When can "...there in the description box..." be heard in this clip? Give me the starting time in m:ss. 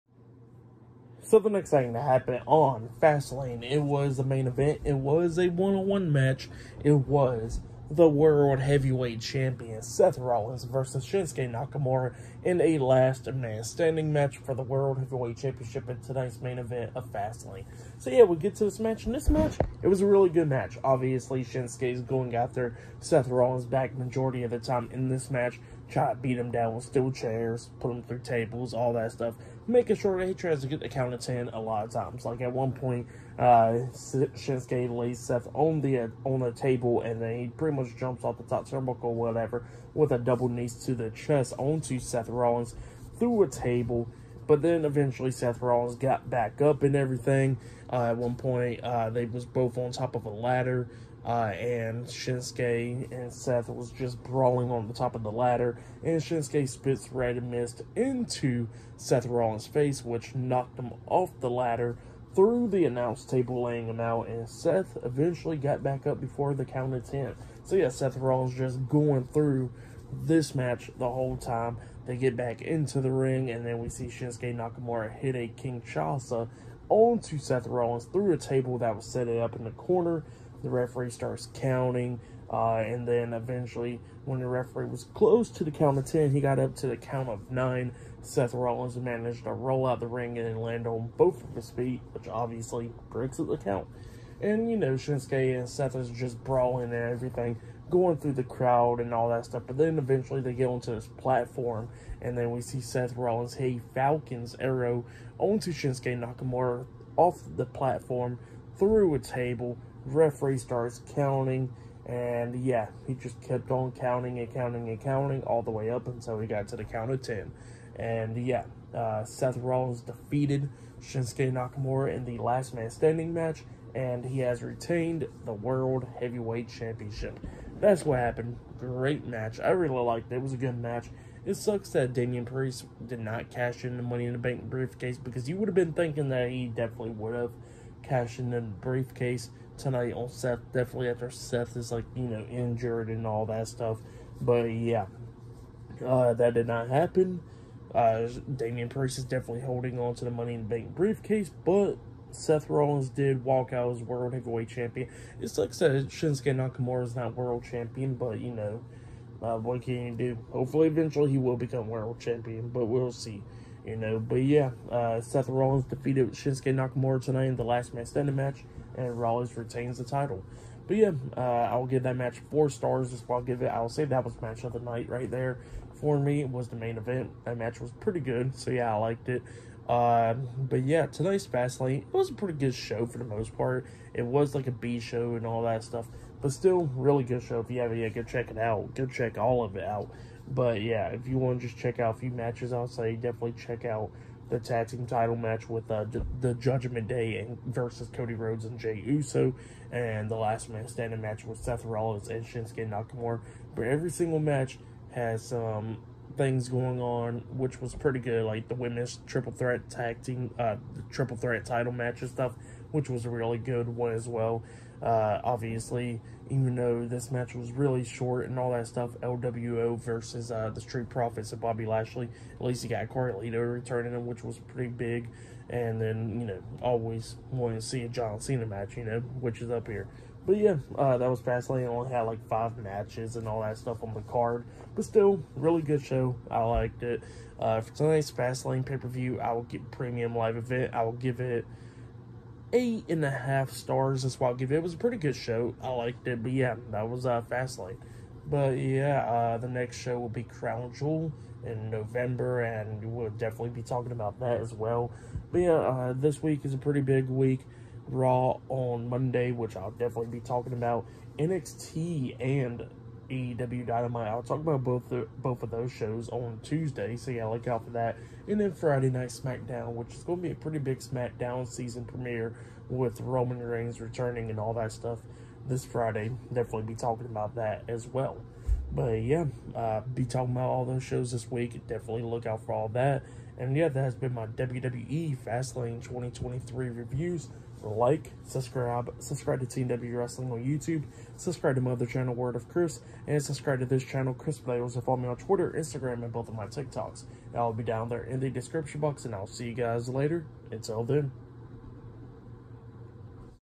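4:58.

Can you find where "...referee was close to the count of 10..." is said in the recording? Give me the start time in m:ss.
1:24.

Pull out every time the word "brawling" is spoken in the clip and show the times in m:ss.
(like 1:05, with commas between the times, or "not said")
0:54, 1:36.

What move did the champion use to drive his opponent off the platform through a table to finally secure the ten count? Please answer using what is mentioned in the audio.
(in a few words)
Falcon's arrow.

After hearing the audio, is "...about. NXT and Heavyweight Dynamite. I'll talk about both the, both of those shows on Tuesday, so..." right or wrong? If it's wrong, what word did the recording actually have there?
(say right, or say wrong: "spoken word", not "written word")
wrong: "AEW", not "Heavyweight".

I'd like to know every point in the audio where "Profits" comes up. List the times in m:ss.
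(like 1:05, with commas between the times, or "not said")
3:41.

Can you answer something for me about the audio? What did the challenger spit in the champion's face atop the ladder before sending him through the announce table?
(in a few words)
red mist.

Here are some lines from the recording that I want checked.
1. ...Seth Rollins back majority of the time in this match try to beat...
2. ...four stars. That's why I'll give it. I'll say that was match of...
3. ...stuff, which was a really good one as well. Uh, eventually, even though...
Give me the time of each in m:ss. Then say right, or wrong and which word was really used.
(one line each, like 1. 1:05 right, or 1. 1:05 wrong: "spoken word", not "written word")
1. 0:22 right
2. 2:52 right
3. 3:32 wrong: "obviously", not "eventually".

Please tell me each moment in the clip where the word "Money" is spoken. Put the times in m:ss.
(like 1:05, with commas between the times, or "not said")
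2:14, 2:30.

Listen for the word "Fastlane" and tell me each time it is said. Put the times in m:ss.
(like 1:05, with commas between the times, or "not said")
0:03, 0:17, 3:01, 3:51, 3:58, 4:07, 4:45.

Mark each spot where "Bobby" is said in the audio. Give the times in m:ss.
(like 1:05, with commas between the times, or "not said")
3:41.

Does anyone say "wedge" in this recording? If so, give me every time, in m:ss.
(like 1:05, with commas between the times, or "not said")
not said.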